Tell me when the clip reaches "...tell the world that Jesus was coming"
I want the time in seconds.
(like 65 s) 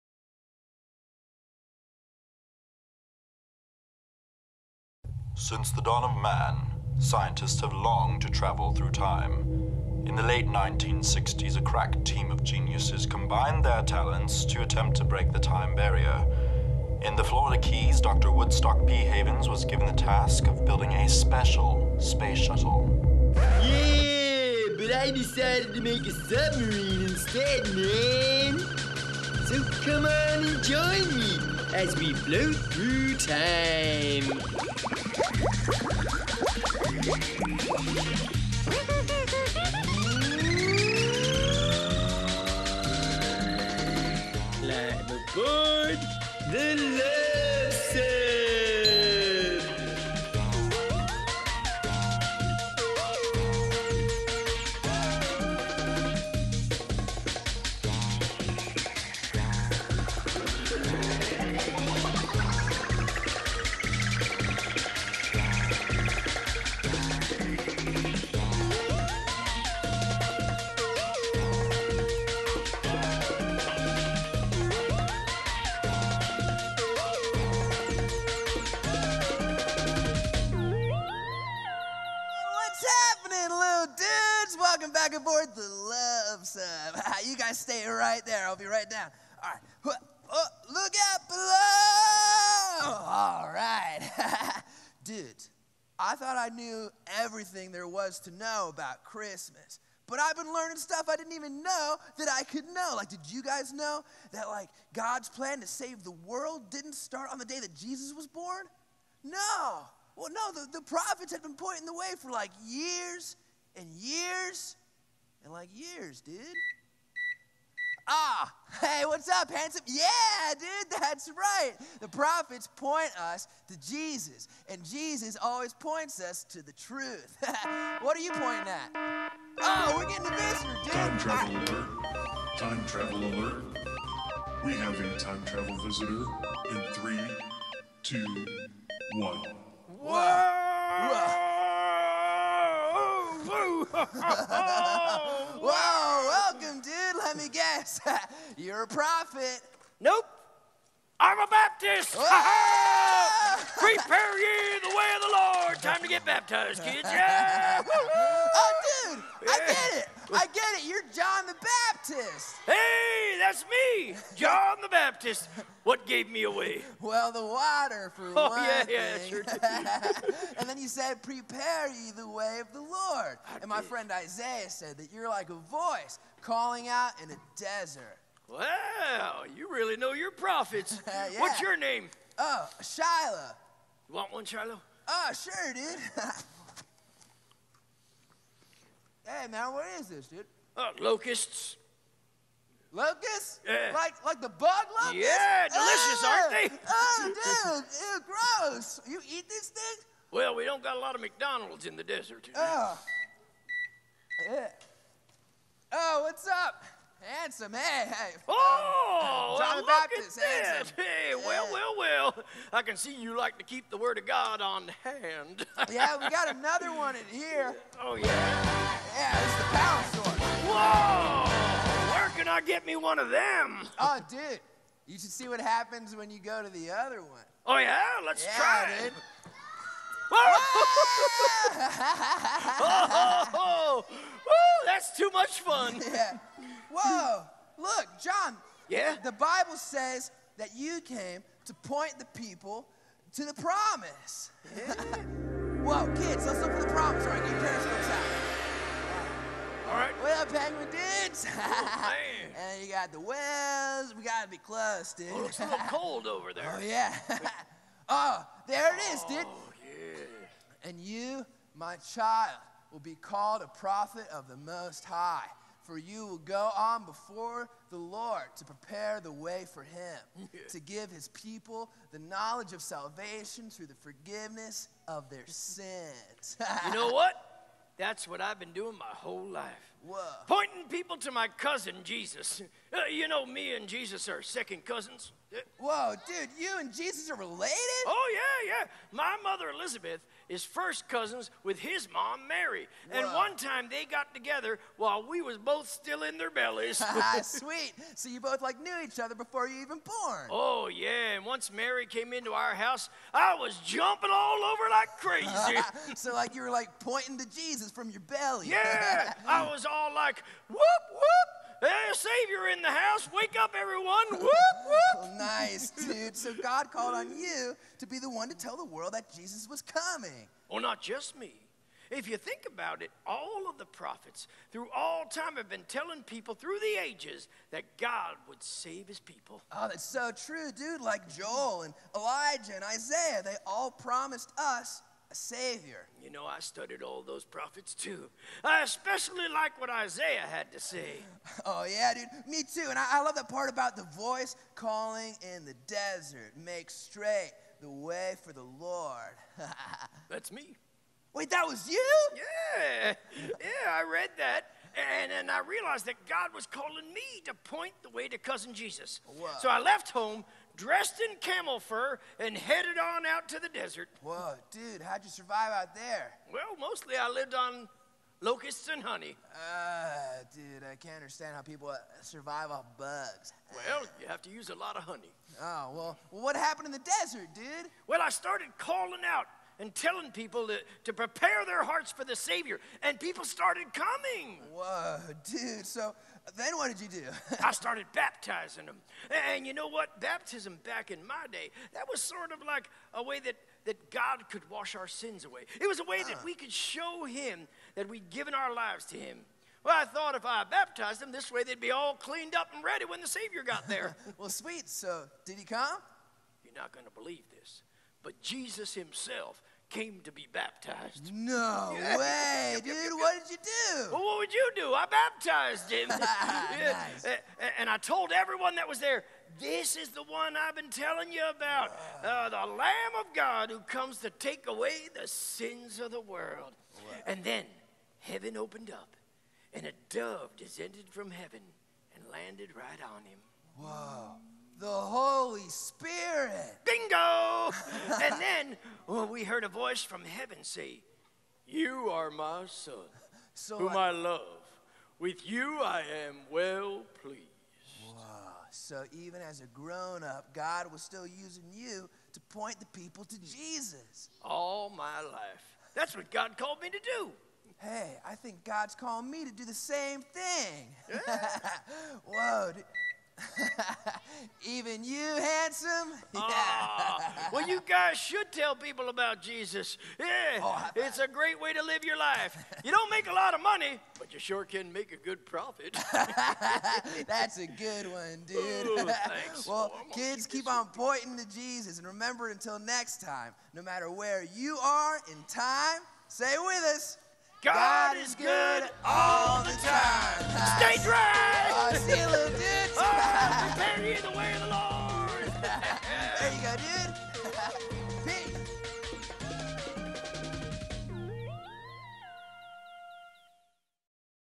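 318 s.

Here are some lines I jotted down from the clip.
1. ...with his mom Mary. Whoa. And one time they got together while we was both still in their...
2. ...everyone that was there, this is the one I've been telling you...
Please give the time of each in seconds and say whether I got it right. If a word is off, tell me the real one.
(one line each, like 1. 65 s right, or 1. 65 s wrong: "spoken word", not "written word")
1. 291 s right
2. 418 s right.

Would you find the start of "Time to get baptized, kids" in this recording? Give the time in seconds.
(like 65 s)
155 s.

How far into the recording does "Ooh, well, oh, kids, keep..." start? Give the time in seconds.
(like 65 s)
478 s.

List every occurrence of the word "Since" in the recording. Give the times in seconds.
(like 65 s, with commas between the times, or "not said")
5 s.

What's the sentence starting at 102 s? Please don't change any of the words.
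Like, did you guys know that, like, God's plan to save the world didn't start on the day that Jesus was born?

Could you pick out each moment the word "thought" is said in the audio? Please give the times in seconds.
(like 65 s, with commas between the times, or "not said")
96 s, 400 s.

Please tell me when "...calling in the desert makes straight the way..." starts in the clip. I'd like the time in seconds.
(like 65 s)
344 s.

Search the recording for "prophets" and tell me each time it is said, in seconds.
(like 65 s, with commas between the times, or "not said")
110 s, 122 s, 148 s, 180 s, 263 s, 323 s, 337 s.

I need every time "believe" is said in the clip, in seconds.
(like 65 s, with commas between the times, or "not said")
407 s.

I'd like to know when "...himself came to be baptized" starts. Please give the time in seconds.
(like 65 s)
408 s.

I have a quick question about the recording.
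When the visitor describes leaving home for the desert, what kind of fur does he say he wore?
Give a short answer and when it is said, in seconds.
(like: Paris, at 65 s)
Camel fur, at 361 s.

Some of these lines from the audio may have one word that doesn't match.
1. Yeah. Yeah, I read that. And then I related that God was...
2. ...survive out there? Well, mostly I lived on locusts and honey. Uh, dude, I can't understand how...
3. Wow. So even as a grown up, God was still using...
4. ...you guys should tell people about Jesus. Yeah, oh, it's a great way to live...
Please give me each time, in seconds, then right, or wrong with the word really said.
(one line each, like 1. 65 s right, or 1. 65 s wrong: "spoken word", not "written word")
1. 352 s wrong: "realized", not "related"
2. 365 s right
3. 448 s right
4. 467 s right.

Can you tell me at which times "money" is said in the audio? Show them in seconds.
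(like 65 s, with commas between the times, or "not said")
473 s.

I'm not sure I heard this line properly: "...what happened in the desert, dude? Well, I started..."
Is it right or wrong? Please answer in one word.
right.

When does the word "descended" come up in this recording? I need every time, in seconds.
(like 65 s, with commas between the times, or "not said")
430 s.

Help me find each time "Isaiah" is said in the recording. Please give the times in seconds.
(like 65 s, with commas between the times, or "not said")
174 s, 332 s, 339 s.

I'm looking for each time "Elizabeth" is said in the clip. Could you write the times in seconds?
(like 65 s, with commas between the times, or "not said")
289 s.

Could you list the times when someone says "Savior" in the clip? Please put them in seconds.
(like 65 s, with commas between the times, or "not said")
312 s, 335 s, 382 s, 403 s.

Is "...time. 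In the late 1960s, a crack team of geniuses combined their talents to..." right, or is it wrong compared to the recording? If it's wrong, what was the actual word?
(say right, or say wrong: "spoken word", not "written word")
right.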